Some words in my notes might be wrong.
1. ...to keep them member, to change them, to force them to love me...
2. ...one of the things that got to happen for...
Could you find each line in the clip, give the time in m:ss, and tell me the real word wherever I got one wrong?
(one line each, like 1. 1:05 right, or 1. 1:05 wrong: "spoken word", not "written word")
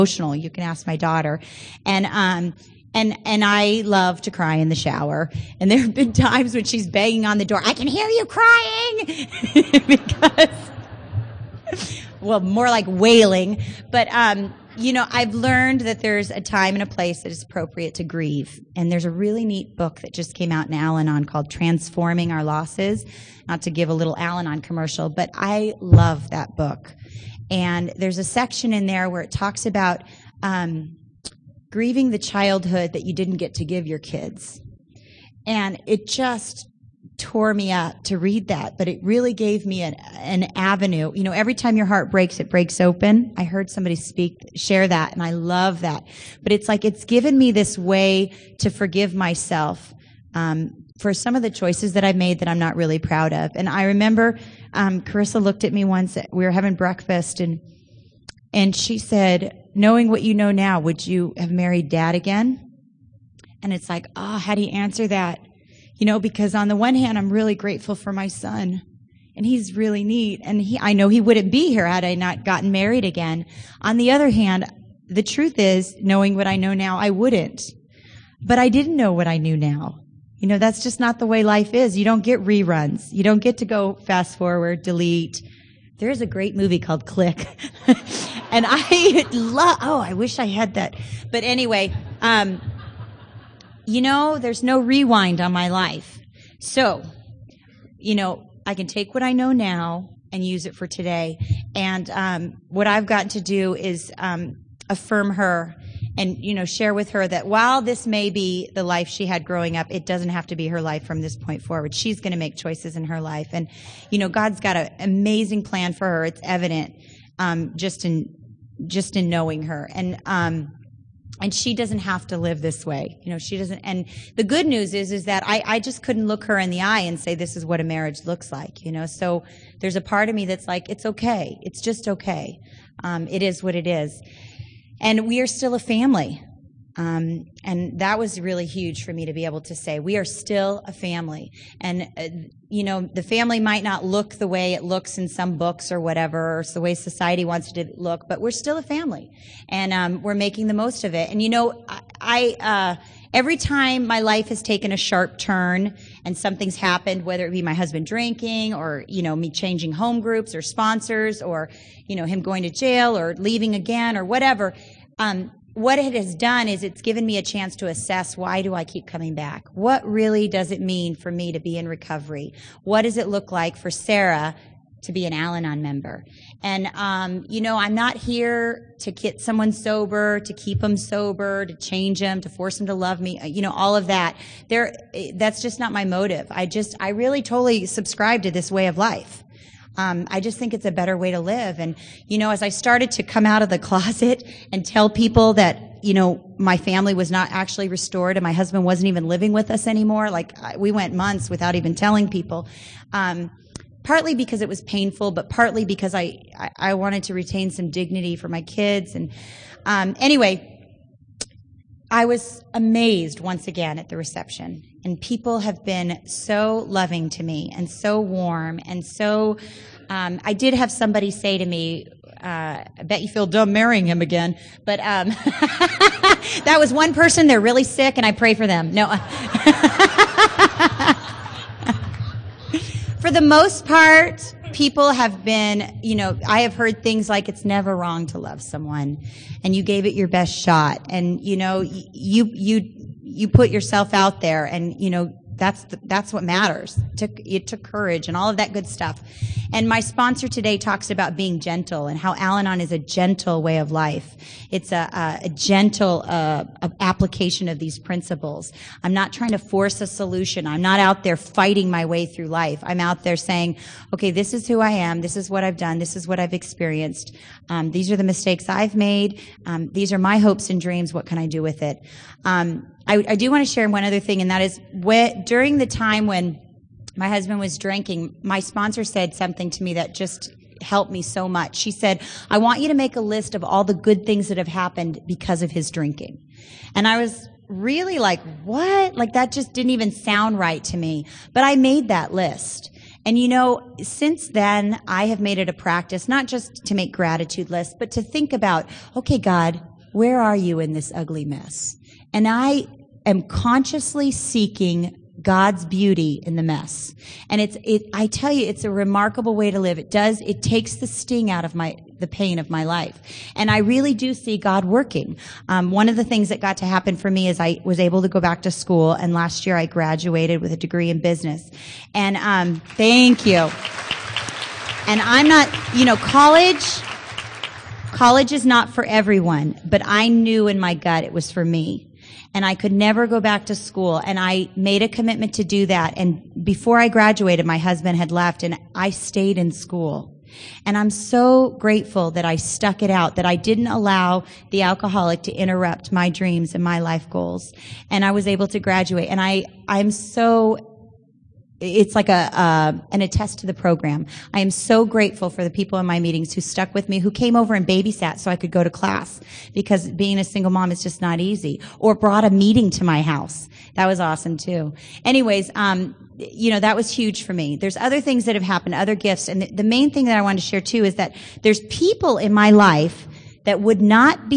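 1. 3:00 wrong: "sober", not "member"
2. 5:15 right.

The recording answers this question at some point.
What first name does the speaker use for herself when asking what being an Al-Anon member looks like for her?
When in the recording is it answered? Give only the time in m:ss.
2:53.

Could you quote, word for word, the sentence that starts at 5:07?
And it's, it, I tell you, it's a remarkable way to live.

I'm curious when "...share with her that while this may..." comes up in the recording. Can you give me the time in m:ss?
1:46.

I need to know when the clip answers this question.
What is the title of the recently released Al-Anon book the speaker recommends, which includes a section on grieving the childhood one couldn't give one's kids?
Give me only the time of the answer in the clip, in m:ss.
0:21.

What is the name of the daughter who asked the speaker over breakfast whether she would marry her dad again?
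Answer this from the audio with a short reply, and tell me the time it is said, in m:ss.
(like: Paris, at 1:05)
Carissa, at 0:55.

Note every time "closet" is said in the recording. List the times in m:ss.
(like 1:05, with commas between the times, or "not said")
3:13.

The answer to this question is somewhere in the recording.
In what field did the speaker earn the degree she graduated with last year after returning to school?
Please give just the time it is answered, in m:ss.
5:21.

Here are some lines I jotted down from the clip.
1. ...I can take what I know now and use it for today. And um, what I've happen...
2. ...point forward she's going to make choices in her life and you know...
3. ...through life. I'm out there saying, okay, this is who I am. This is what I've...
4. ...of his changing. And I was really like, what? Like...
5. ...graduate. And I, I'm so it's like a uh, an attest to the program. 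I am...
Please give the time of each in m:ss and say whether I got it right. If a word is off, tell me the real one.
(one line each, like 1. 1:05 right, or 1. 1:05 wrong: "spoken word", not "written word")
1. 1:38 wrong: "gotten", not "happen"
2. 1:51 right
3. 4:22 right
4. 4:45 wrong: "drinking", not "changing"
5. 5:48 right.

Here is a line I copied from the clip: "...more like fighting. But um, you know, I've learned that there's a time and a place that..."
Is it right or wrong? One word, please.
wrong.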